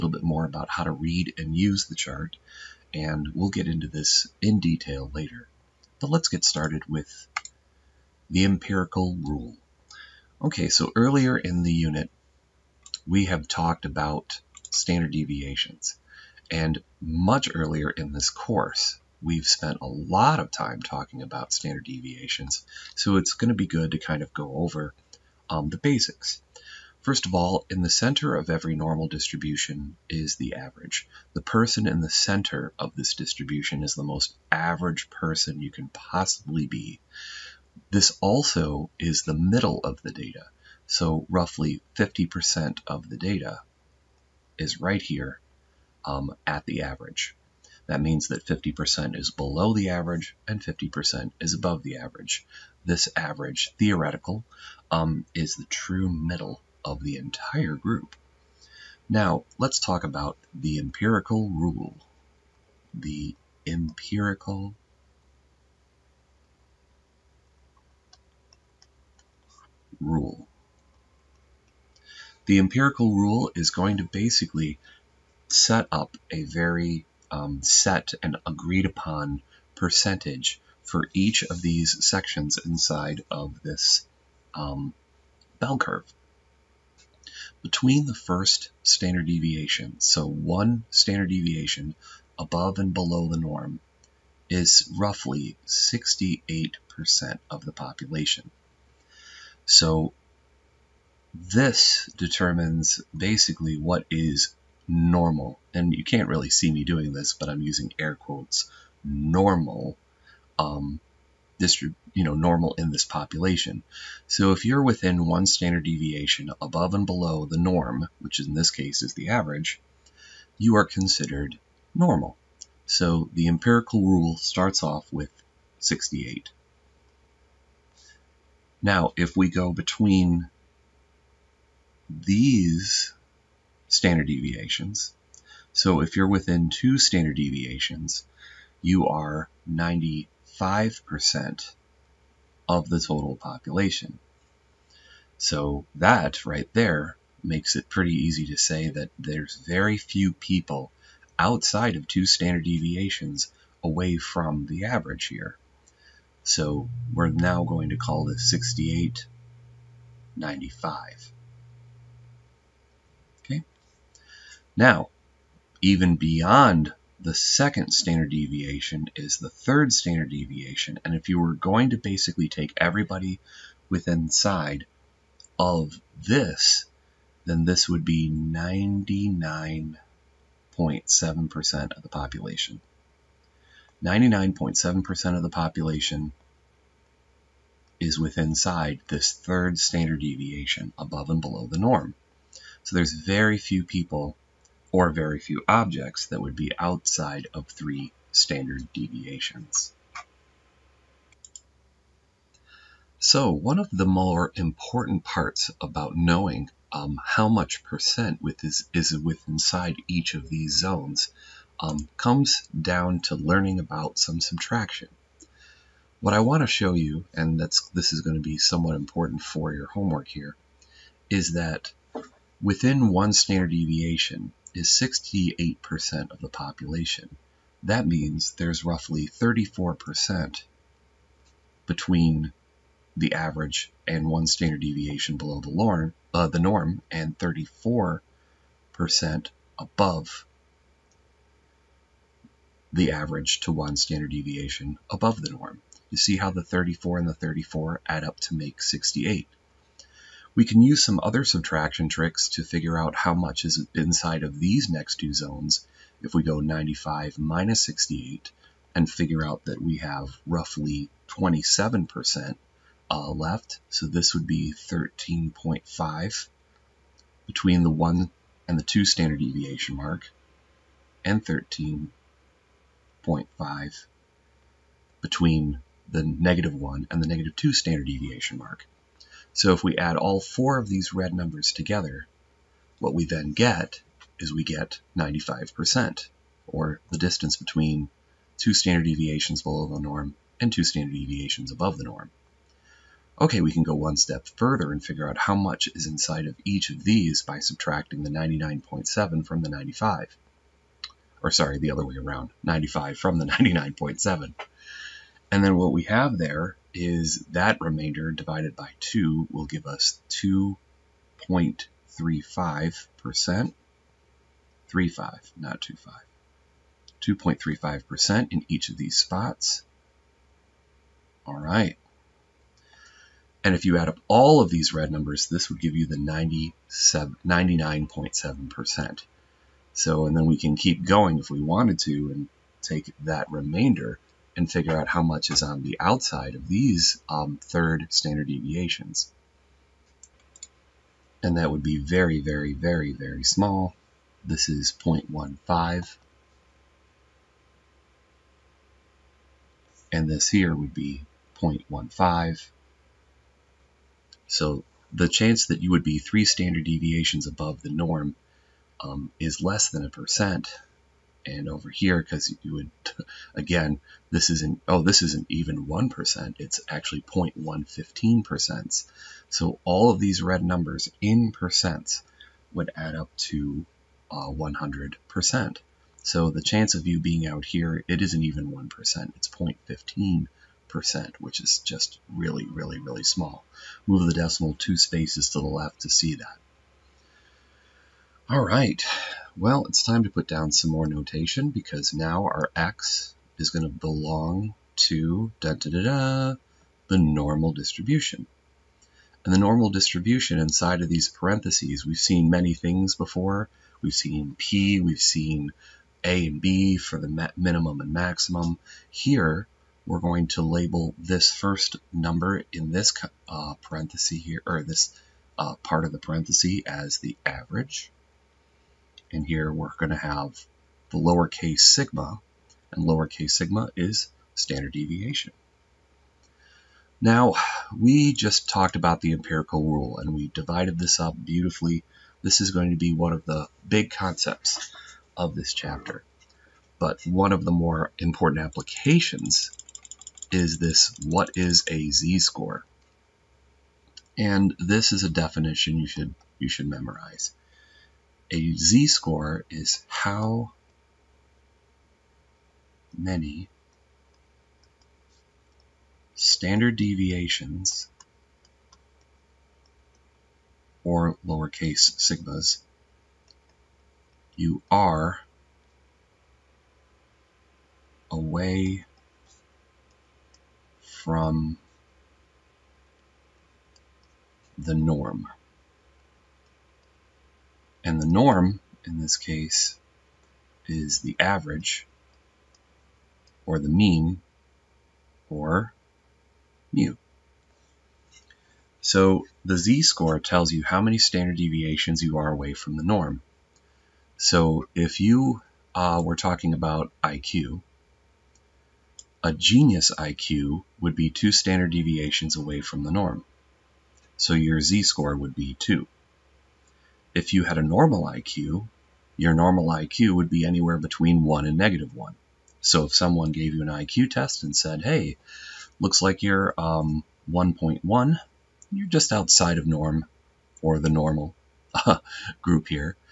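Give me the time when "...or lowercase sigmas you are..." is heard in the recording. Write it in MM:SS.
07:41.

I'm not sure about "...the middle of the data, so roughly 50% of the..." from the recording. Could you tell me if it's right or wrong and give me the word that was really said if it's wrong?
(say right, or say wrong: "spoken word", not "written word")
right.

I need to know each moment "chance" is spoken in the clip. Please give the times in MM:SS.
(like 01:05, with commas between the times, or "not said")
05:55, 06:16.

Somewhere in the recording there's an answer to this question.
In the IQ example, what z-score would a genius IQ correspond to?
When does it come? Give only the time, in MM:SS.
08:24.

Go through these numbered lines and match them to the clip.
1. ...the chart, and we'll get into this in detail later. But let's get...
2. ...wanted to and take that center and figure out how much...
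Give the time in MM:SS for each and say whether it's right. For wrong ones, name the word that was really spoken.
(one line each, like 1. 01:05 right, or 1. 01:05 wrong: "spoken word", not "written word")
1. 00:01 right
2. 05:31 wrong: "remainder", not "center".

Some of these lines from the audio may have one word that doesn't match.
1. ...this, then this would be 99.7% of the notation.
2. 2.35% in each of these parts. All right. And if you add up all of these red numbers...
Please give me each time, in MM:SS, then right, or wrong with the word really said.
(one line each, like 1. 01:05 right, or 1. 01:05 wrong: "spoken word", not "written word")
1. 02:56 wrong: "population", not "notation"
2. 05:17 wrong: "spots", not "parts".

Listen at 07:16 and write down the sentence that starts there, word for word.
But one of the more important applications is this, what is a z-score?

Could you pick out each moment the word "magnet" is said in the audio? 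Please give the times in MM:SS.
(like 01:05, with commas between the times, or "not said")
not said.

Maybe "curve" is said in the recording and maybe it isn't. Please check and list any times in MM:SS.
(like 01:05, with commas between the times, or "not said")
01:25.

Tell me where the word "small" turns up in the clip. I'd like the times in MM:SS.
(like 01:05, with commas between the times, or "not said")
05:43, 06:23.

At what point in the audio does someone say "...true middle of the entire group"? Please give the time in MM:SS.
00:55.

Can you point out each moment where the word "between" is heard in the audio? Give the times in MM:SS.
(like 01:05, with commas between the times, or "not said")
01:27, 02:09, 03:51, 04:27, 04:35, 04:47, 08:30.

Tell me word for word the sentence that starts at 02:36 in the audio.
So we're now going to call this 68, 95.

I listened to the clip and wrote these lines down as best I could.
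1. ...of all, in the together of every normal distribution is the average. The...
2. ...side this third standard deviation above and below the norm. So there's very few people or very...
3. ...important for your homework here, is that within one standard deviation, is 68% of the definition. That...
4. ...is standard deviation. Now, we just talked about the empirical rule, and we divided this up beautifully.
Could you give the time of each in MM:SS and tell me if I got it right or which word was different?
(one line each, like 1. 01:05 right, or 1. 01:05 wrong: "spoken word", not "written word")
1. 00:27 wrong: "center", not "together"
2. 03:08 right
3. 03:38 wrong: "population", not "definition"
4. 07:03 right.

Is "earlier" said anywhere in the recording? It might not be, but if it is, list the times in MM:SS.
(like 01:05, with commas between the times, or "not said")
00:10, 00:17.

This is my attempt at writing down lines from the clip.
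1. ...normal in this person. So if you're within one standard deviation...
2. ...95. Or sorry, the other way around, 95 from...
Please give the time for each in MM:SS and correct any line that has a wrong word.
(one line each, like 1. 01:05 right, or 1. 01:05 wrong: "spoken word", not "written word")
1. 01:52 wrong: "population", not "person"
2. 04:59 right.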